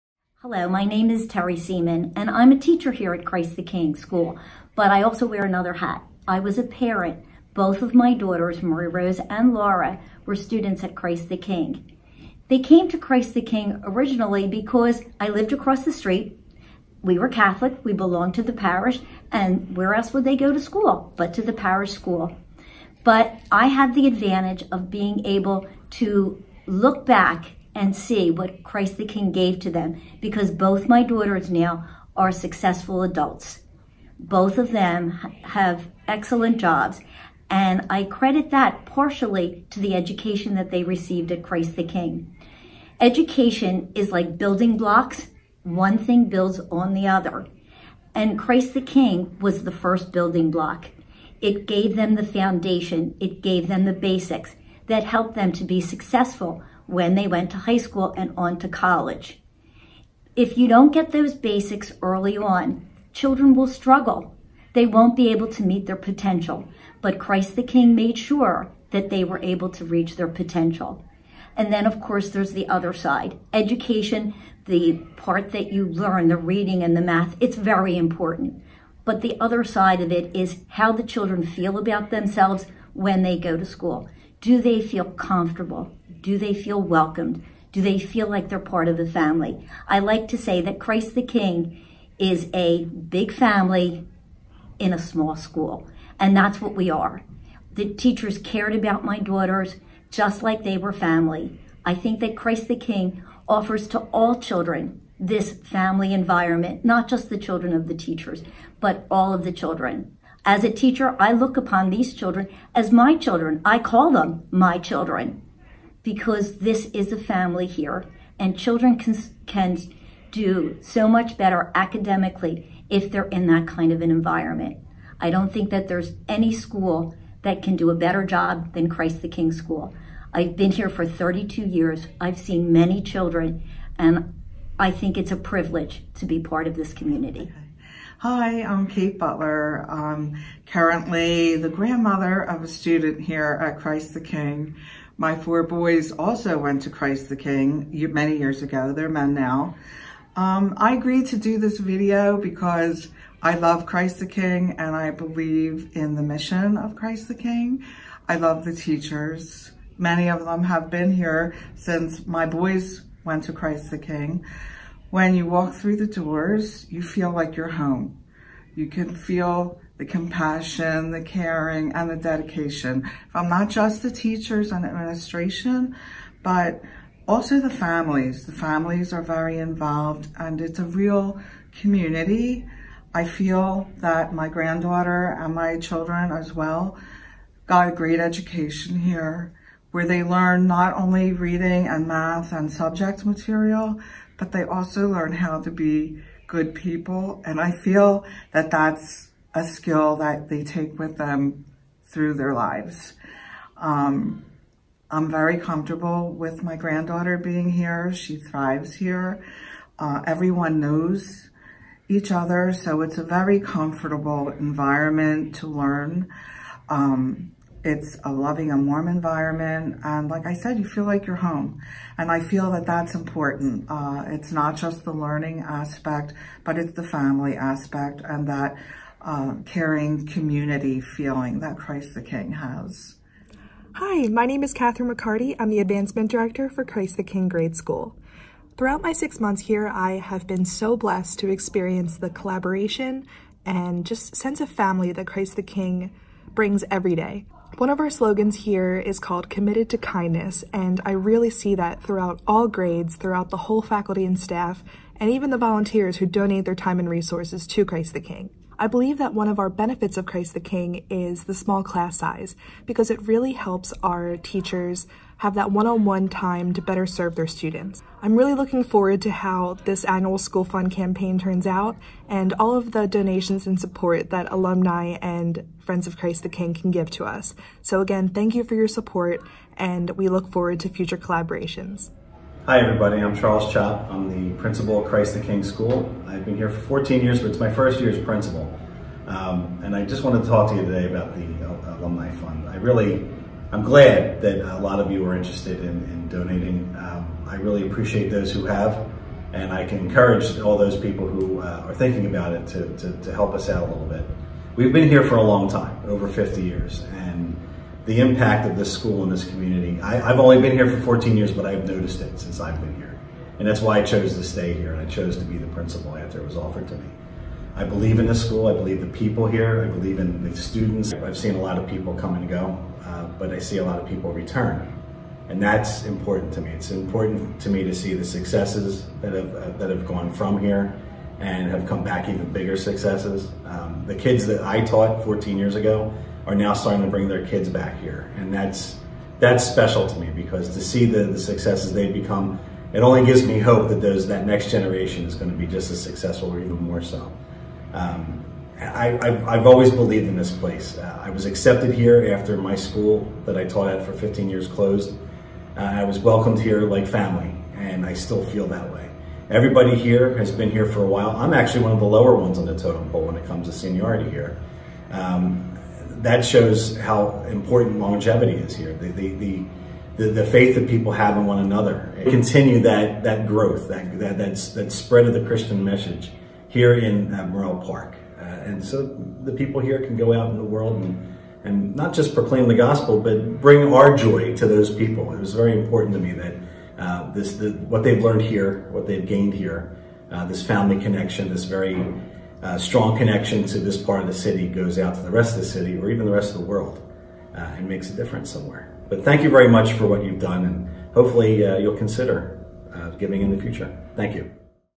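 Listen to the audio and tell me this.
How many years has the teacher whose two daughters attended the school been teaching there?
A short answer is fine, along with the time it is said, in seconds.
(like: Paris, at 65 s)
32, at 131 s.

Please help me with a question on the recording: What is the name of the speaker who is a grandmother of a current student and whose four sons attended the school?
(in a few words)
Kate Butler.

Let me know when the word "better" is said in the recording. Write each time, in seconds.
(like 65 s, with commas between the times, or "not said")
121 s, 127 s, 266 s.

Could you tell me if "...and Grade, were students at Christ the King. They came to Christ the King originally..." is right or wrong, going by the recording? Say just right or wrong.
wrong.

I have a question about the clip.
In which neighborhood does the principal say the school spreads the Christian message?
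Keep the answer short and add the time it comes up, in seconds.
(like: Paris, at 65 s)
Morrell Park, at 377 s.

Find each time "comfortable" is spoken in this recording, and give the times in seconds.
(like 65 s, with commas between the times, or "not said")
85 s, 205 s, 213 s.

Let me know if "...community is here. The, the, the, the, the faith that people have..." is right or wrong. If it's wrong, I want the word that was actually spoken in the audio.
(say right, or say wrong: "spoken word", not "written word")
wrong: "longevity", not "community".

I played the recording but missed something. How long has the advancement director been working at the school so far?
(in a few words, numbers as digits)
6 months.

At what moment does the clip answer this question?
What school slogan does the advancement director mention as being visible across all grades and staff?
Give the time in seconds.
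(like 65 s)
249 s.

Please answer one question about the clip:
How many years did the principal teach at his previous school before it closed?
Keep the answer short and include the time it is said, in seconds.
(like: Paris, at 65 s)
15, at 354 s.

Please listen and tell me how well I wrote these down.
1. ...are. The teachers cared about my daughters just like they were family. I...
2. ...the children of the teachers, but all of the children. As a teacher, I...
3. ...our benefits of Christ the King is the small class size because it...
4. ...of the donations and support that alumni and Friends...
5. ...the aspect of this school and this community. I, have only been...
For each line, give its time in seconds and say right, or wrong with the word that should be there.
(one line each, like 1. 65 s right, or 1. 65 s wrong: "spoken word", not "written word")
1. 96 s right
2. 107 s right
3. 259 s right
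4. 272 s right
5. 308 s wrong: "impact", not "aspect".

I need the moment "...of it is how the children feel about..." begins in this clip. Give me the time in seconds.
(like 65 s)
80 s.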